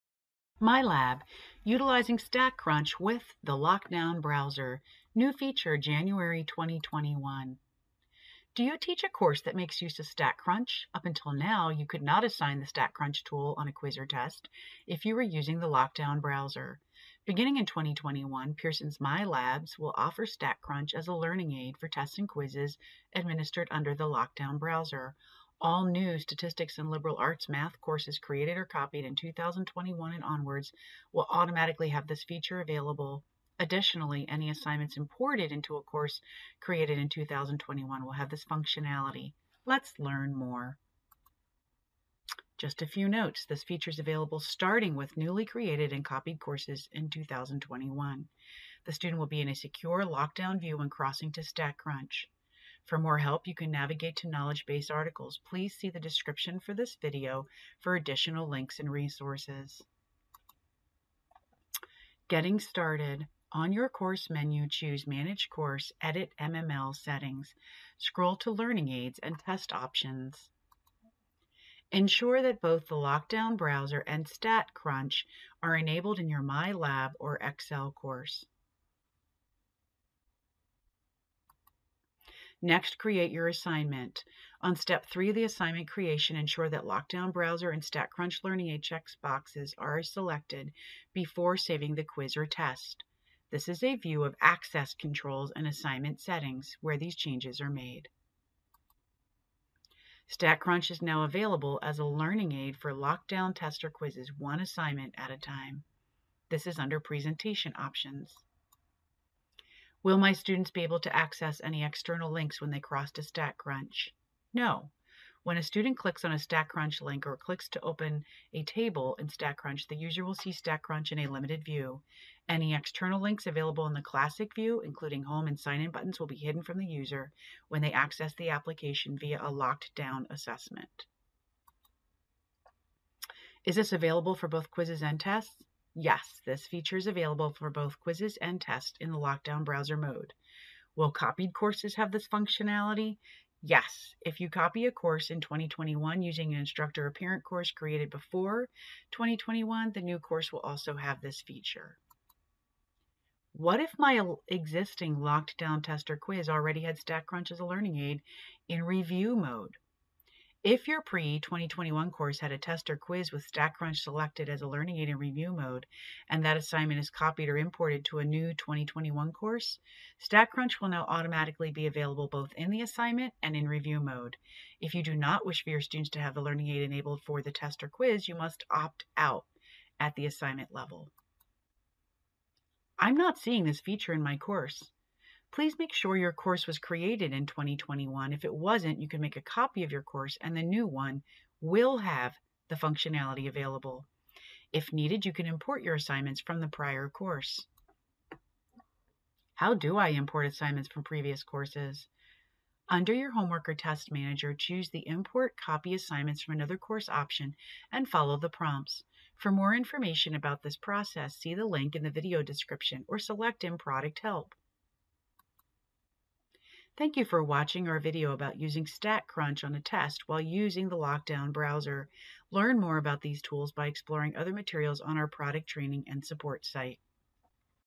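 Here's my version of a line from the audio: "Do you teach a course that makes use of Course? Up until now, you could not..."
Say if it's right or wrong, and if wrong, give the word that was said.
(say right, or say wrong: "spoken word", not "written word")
wrong: "StatCrunch", not "Course".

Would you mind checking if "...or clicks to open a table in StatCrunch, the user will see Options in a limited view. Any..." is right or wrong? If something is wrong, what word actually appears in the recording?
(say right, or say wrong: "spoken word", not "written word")
wrong: "StatCrunch", not "Options".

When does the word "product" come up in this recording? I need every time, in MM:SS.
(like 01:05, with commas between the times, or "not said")
03:33, 03:45.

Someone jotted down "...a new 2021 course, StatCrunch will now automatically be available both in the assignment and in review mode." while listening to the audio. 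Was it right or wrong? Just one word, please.
right.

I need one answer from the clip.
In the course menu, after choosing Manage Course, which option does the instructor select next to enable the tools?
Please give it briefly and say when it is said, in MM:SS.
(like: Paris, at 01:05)
Edit MML Settings, at 01:06.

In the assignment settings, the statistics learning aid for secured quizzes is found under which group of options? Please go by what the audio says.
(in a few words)
Presentation Options.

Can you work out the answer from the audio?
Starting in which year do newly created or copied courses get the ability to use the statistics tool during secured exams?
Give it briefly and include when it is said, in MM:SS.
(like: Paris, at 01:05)
2021, at 00:17.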